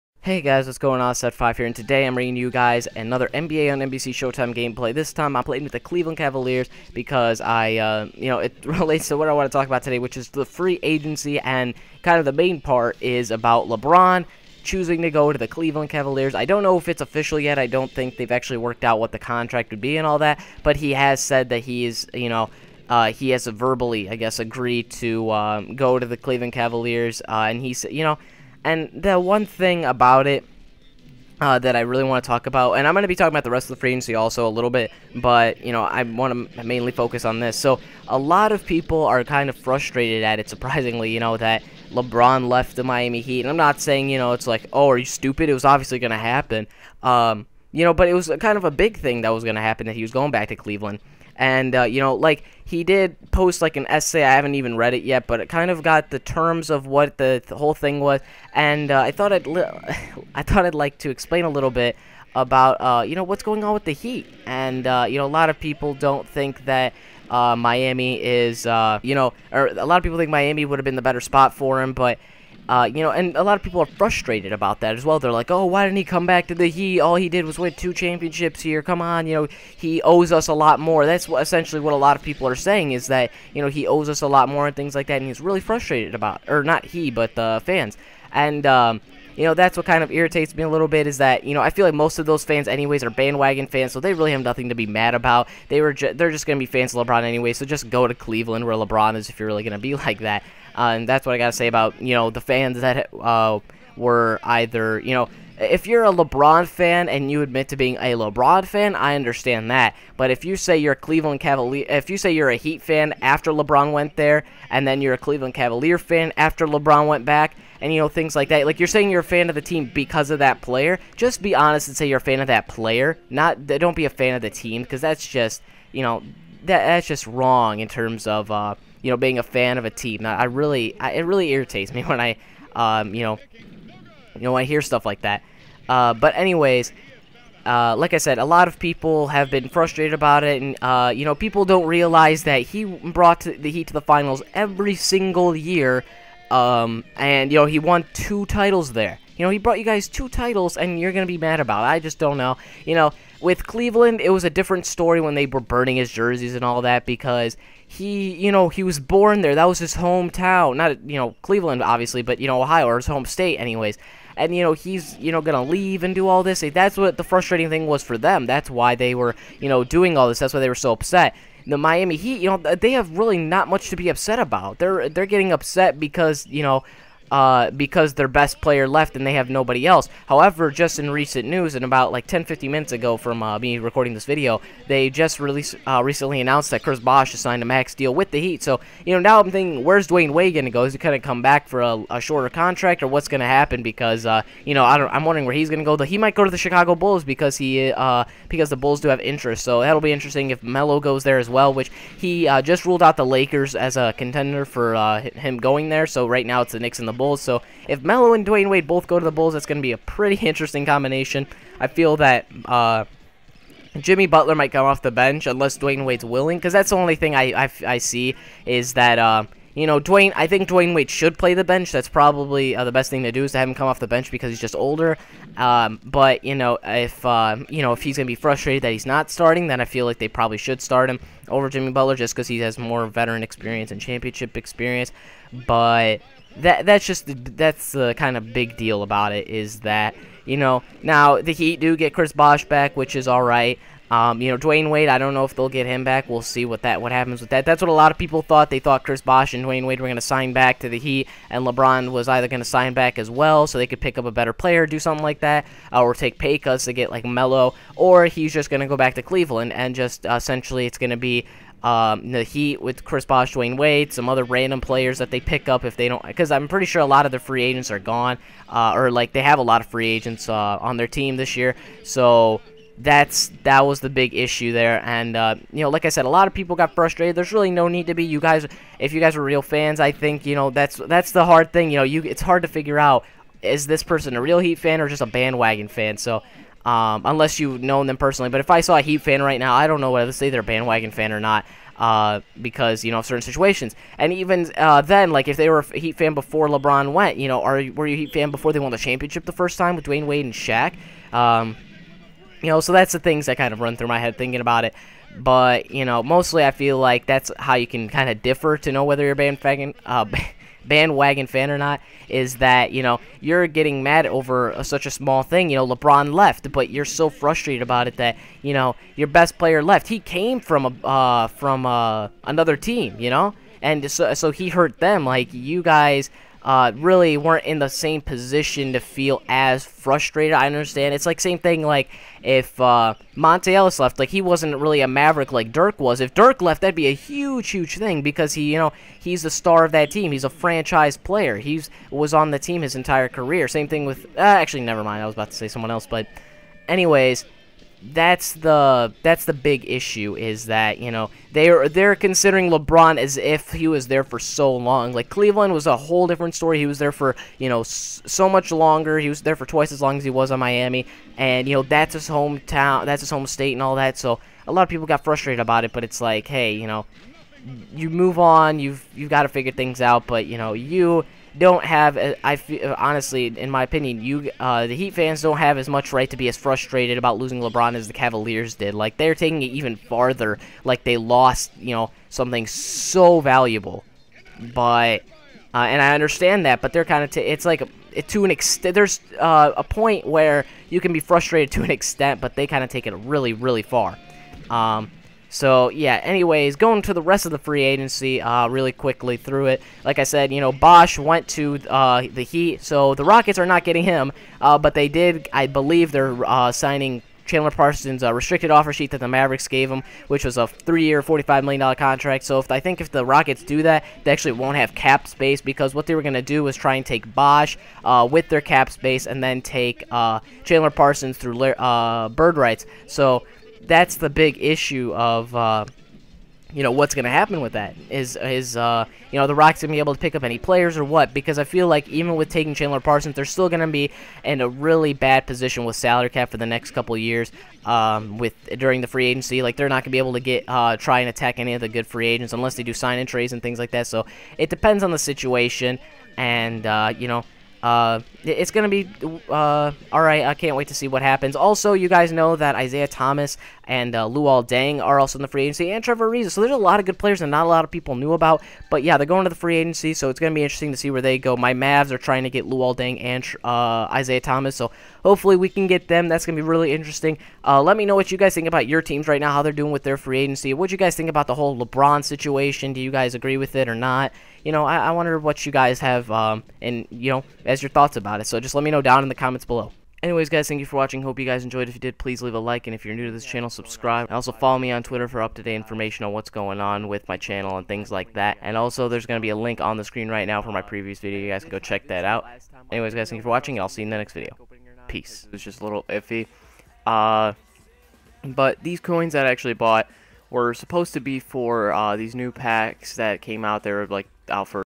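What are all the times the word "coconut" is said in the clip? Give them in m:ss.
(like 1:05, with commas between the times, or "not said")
not said.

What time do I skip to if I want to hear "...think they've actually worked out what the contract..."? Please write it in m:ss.
0:17.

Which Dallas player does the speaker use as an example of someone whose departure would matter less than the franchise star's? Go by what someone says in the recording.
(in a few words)
Monta Ellis.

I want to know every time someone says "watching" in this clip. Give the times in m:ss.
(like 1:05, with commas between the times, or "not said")
8:00, 8:13.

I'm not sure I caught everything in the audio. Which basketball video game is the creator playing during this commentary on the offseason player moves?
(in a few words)
NBA on NBC Showtime.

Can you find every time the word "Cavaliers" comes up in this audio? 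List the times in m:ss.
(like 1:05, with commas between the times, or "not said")
0:06, 0:15, 0:26, 1:51, 1:55, 6:18.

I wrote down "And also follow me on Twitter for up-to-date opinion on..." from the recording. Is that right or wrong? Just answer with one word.
wrong.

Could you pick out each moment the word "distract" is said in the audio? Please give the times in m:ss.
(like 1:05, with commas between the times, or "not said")
not said.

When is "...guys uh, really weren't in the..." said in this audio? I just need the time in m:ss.
5:25.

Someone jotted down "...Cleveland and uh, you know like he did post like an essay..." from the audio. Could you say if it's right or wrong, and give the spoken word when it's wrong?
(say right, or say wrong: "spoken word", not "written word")
right.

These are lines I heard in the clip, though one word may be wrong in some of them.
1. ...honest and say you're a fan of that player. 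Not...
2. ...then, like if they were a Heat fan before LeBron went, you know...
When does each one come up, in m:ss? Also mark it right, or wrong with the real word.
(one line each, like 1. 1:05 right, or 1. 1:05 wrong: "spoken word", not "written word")
1. 2:01 right
2. 4:55 right.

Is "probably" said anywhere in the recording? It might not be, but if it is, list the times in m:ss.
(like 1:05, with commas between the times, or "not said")
3:42, 3:50.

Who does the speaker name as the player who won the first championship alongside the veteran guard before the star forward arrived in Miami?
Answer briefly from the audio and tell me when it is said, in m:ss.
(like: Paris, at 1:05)
Shaq, at 5:00.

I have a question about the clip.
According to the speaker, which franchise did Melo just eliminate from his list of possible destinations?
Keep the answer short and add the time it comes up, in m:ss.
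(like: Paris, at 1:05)
the Lakers, at 3:23.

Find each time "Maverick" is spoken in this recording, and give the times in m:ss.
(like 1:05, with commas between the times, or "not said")
5:35, 6:49.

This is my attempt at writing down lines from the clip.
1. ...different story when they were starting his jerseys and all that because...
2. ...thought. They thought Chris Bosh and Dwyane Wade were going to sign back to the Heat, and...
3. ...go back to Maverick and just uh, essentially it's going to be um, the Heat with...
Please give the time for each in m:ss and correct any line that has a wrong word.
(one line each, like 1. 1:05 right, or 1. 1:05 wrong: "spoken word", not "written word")
1. 2:34 wrong: "burning", not "starting"
2. 4:08 right
3. 4:18 wrong: "Cleveland", not "Maverick".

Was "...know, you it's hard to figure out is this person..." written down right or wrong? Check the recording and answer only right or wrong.
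right.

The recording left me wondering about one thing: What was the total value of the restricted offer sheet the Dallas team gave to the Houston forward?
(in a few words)
$45 million.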